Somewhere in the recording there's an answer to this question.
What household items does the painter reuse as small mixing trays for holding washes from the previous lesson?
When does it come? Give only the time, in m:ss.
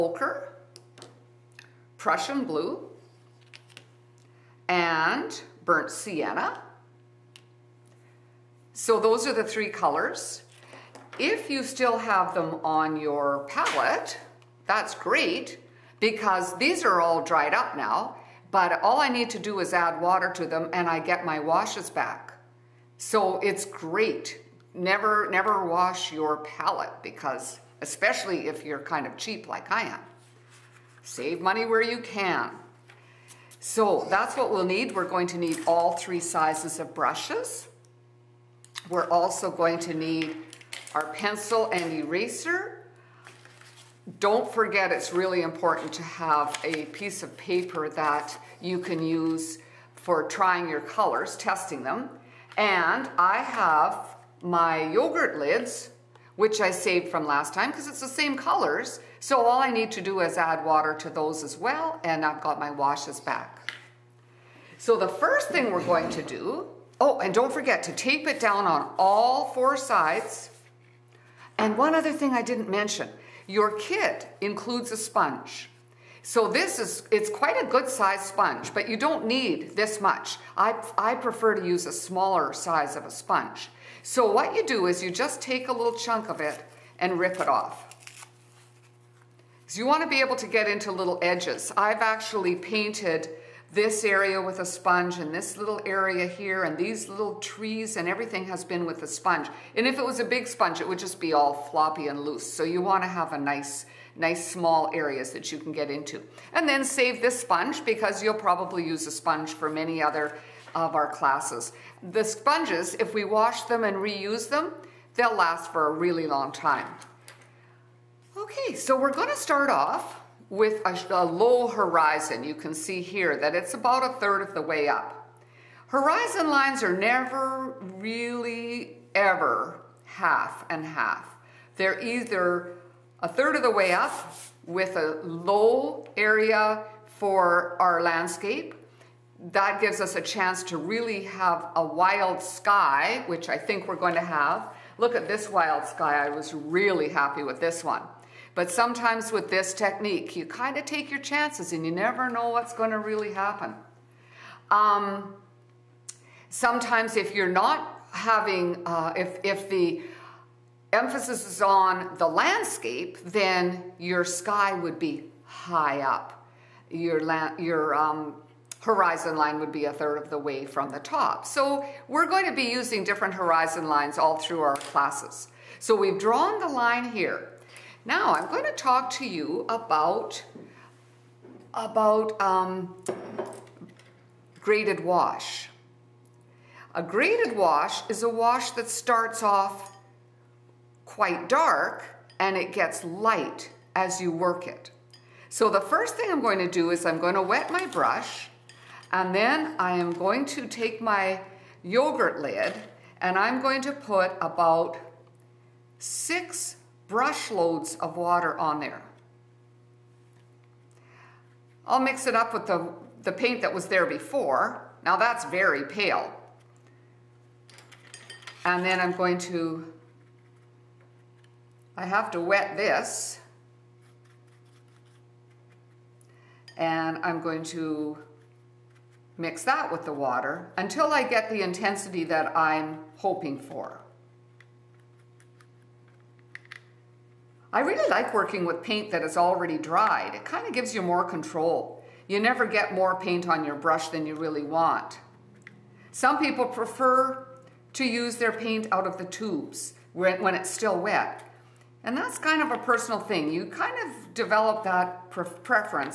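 0:54.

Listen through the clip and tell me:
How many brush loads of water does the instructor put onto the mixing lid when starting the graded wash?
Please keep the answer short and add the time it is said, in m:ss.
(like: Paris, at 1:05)
6, at 3:25.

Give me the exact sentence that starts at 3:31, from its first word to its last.
I'll mix it up with the, the paint that was there before.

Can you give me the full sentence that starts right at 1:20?
I, I prefer to use a smaller size of a sponge.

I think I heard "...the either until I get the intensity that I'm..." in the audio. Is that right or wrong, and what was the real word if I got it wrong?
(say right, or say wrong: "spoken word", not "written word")
wrong: "water", not "either".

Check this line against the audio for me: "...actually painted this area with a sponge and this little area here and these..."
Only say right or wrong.
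right.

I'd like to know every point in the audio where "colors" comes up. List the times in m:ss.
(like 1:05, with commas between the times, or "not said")
0:09, 0:50, 0:58.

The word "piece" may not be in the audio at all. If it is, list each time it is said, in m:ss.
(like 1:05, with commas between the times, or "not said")
0:46.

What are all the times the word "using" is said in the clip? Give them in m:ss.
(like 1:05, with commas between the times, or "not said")
2:52.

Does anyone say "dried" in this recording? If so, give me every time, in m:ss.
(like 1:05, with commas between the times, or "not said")
0:17, 3:59.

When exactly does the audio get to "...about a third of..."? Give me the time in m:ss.
2:03.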